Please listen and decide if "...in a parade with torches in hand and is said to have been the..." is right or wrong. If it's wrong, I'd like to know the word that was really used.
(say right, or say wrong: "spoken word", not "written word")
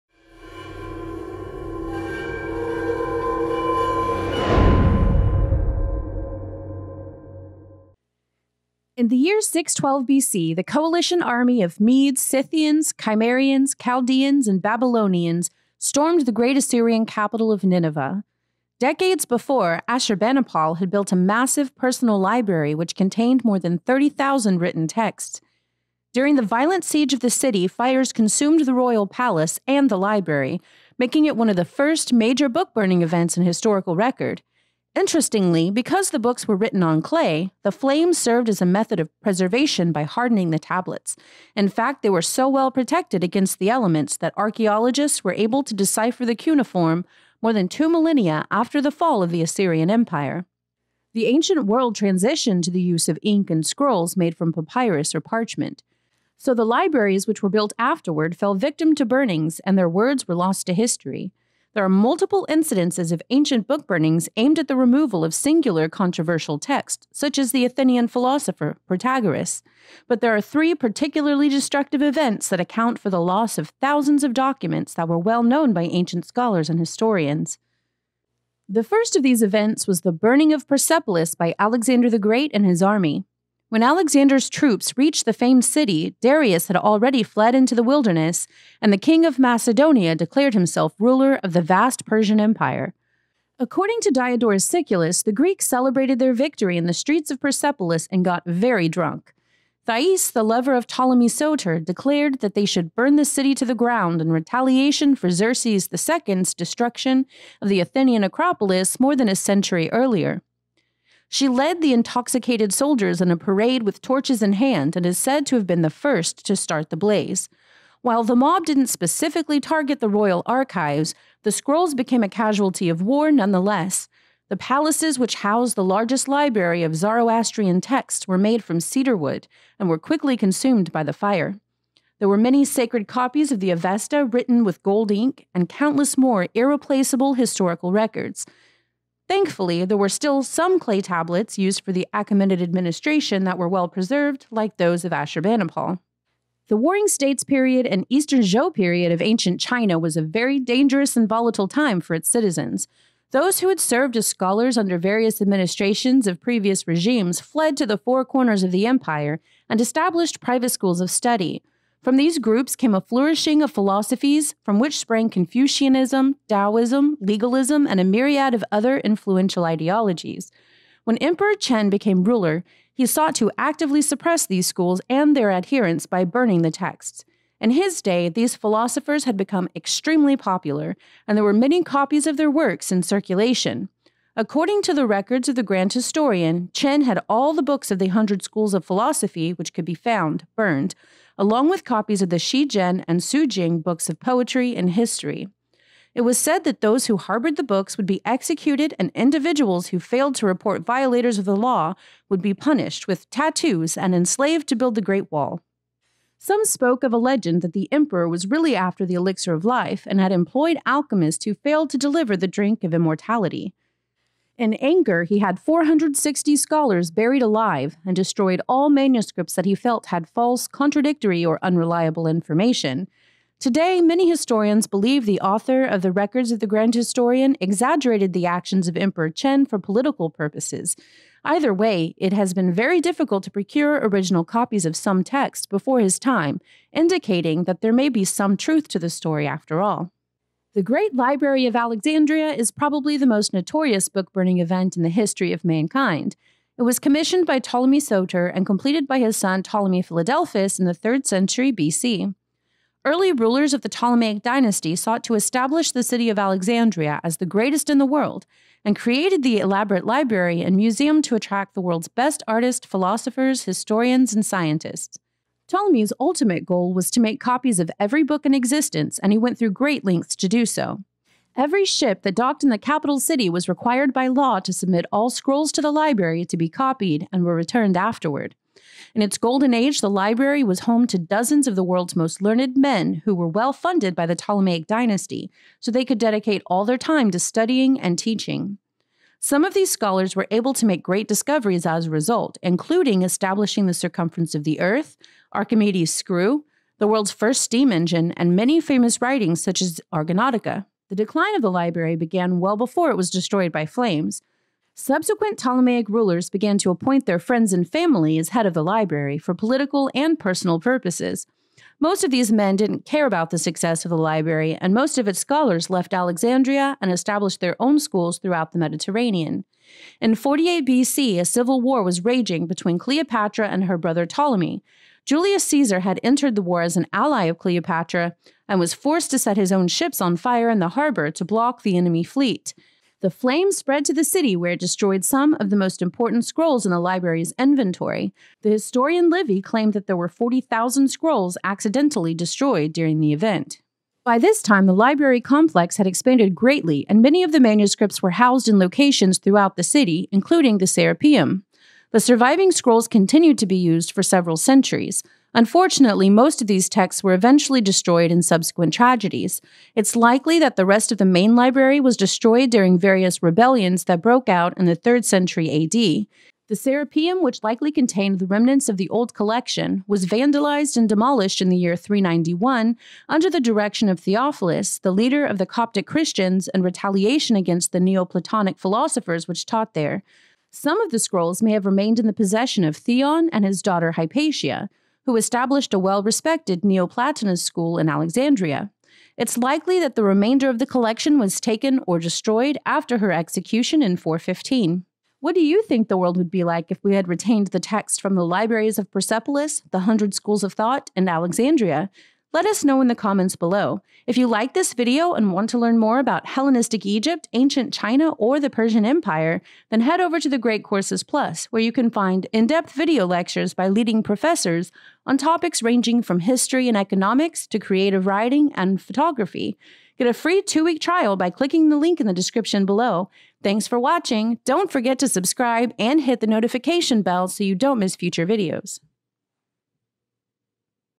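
right.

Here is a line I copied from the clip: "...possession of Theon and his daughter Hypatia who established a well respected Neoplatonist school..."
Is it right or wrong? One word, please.
right.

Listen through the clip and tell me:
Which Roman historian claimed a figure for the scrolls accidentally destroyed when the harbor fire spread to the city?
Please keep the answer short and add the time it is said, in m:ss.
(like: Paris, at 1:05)
Livy, at 5:39.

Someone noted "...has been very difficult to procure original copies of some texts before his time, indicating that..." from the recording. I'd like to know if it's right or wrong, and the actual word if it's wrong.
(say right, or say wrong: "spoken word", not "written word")
right.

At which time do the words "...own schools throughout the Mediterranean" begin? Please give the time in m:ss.
5:17.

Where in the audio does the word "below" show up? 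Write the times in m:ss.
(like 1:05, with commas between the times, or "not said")
6:43, 7:02.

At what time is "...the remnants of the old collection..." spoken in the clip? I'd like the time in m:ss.
6:08.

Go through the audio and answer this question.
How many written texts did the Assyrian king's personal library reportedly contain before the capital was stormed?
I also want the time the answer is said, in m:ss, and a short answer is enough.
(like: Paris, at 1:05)
more than 30,000, at 0:23.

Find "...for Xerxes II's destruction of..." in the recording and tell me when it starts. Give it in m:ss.
1:45.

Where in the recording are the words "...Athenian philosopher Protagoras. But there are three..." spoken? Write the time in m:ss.
1:07.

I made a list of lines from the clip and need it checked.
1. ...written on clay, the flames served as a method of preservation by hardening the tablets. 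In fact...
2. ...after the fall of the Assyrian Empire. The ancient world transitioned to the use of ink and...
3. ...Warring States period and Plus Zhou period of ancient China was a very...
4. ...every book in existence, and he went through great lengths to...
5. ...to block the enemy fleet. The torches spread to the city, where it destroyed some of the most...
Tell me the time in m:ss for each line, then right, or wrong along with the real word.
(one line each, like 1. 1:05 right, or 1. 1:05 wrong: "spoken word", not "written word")
1. 0:36 right
2. 0:48 right
3. 2:26 wrong: "Eastern", not "Plus"
4. 4:27 right
5. 5:31 wrong: "flames", not "torches".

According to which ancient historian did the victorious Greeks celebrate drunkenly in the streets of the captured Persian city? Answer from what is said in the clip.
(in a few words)
Diodorus Siculus.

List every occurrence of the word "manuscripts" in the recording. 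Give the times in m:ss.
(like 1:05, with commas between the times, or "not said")
3:38, 5:47.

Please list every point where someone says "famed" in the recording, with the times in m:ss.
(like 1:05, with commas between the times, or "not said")
1:25.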